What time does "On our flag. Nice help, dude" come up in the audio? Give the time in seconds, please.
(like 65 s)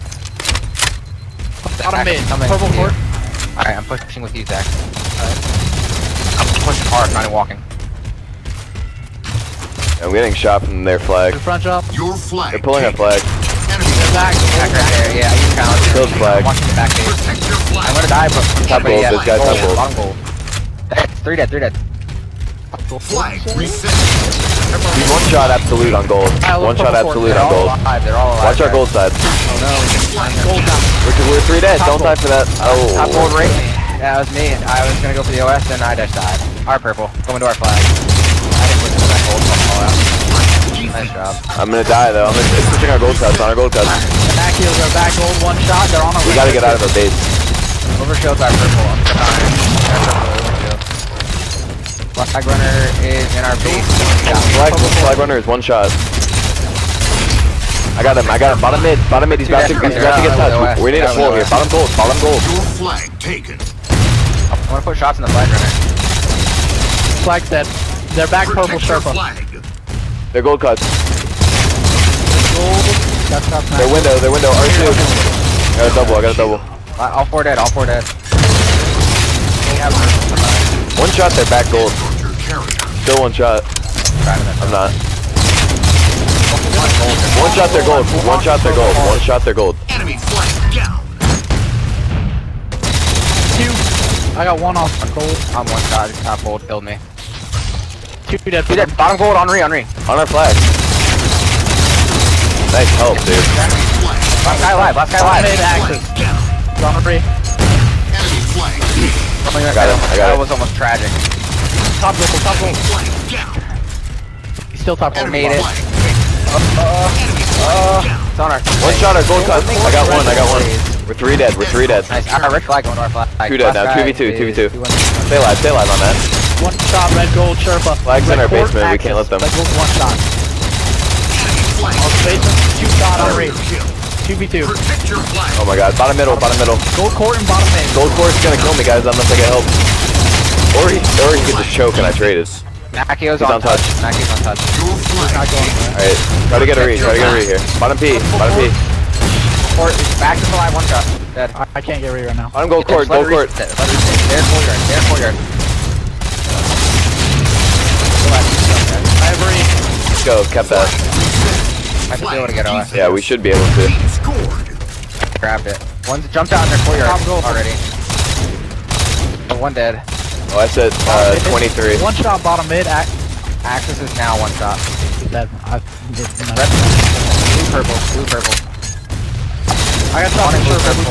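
100 s.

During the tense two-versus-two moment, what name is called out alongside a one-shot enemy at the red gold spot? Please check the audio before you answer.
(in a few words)
Sherpa.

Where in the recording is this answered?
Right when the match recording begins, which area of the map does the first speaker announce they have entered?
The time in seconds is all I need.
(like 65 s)
2 s.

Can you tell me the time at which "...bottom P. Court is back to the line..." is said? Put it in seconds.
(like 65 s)
148 s.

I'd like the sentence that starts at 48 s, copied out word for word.
Overkill's our purple, I'm Flag runner is in our base.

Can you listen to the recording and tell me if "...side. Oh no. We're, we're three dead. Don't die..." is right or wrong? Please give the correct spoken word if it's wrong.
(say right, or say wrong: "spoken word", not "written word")
right.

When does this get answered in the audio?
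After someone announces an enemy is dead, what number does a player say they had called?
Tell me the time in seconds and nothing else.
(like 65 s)
171 s.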